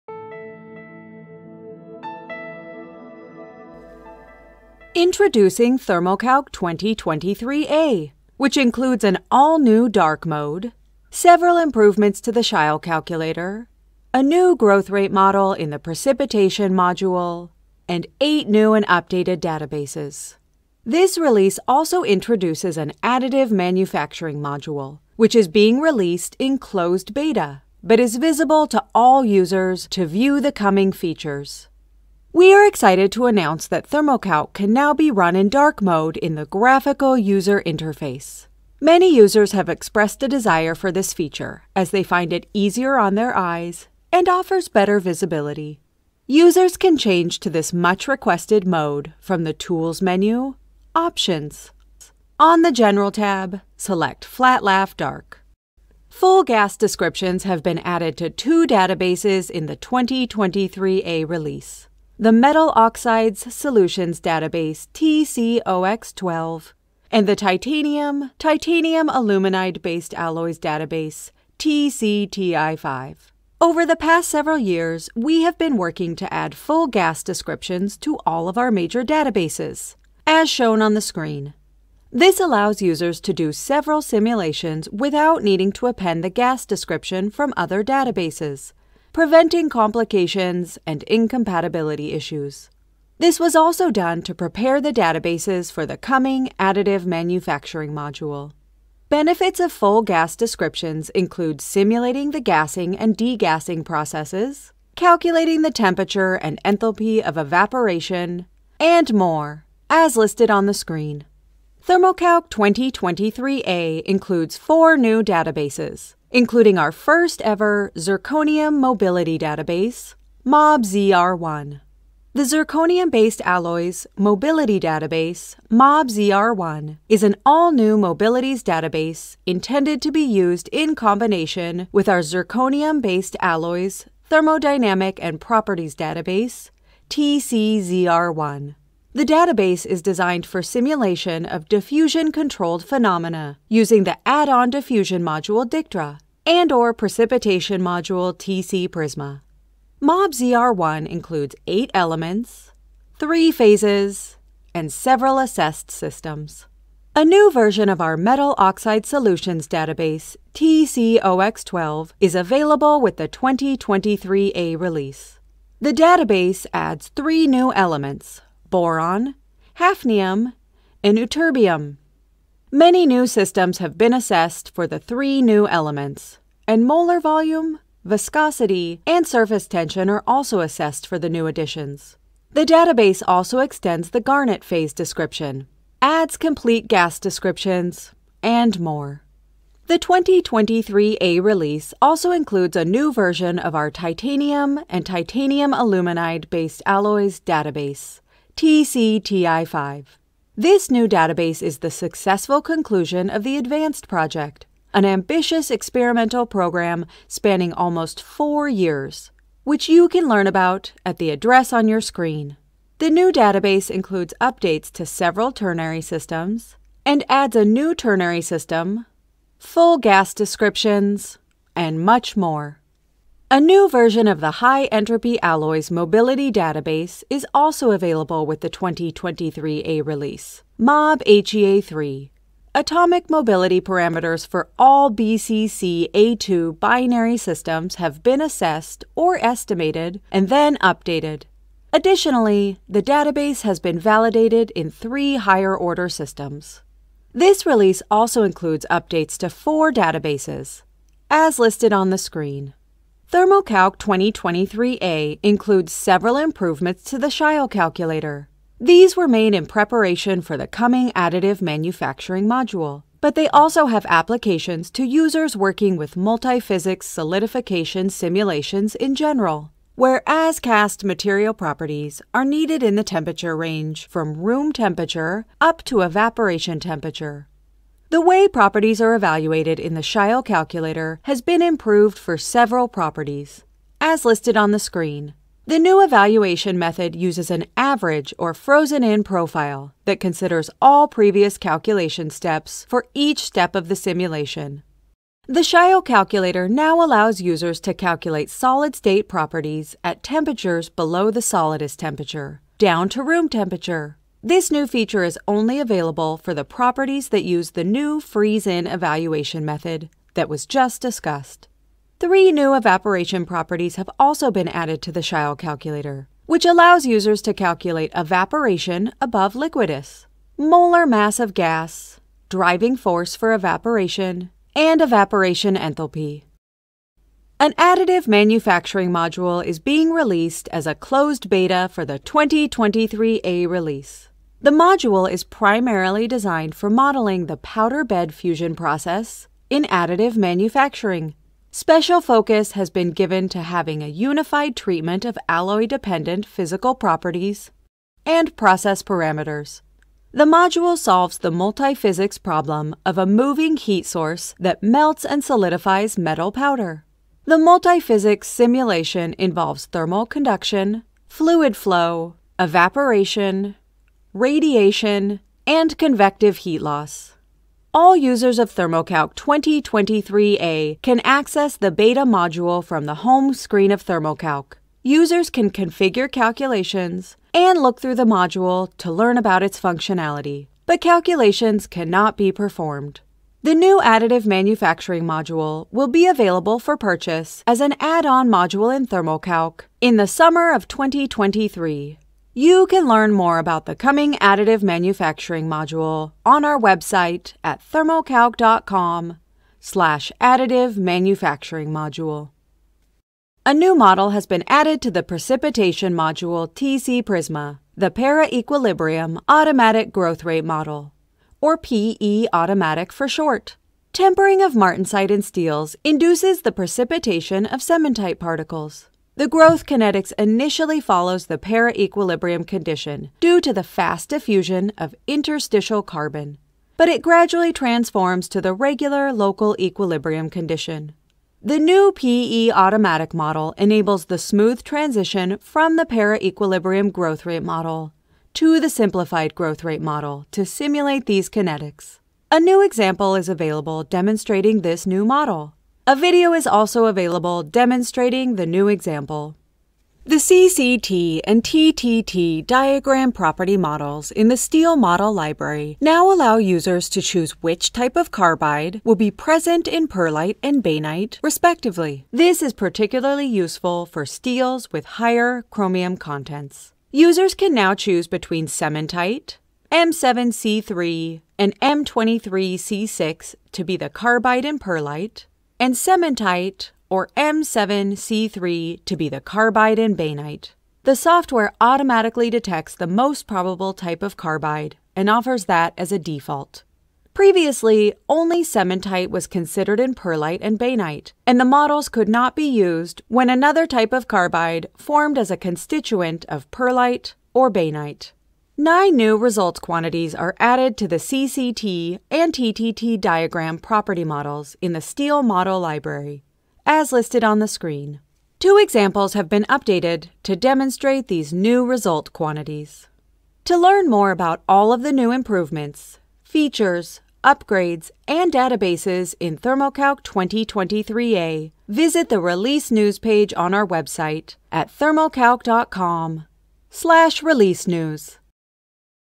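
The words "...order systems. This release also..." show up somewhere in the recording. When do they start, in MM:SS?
04:05.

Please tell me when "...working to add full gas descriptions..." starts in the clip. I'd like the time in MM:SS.
01:15.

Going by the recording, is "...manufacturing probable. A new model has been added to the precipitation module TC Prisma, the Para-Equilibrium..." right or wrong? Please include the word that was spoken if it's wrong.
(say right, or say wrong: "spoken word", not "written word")
wrong: "module", not "probable".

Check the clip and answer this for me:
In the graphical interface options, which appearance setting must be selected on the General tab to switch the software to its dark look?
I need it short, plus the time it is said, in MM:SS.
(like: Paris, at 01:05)
FlatLaf Dark, at 00:54.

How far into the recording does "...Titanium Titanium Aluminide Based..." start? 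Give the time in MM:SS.
01:07.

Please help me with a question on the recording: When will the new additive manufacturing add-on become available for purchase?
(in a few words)
summer of 2023.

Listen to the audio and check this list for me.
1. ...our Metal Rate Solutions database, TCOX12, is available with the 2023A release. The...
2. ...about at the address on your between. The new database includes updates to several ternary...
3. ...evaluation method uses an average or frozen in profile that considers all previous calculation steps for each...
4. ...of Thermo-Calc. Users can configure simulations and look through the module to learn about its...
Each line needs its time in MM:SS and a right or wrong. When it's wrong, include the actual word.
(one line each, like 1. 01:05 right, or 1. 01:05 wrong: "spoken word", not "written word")
1. 02:37 wrong: "Oxide", not "Rate"
2. 03:30 wrong: "screen", not "between"
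3. 04:46 right
4. 06:13 wrong: "calculations", not "simulations".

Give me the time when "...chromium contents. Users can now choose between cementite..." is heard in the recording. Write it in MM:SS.
07:45.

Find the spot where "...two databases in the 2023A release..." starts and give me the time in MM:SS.
00:58.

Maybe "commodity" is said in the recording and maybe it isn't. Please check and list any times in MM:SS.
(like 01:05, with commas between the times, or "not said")
not said.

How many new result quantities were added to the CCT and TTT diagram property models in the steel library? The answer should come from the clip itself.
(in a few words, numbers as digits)
9.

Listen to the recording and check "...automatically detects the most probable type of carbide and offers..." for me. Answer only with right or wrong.
right.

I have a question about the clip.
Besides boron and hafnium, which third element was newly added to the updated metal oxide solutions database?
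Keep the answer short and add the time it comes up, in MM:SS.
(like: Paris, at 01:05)
ytterbium, at 02:51.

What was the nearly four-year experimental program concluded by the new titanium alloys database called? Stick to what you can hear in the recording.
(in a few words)
Advanced Project.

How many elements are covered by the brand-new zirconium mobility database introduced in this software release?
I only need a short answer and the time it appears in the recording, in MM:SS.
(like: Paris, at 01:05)
8, at 02:31.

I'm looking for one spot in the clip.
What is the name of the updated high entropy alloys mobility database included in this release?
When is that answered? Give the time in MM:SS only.
03:50.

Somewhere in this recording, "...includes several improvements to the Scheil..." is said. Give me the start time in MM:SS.
04:15.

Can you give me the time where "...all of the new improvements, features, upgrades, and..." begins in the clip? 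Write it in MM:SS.
08:34.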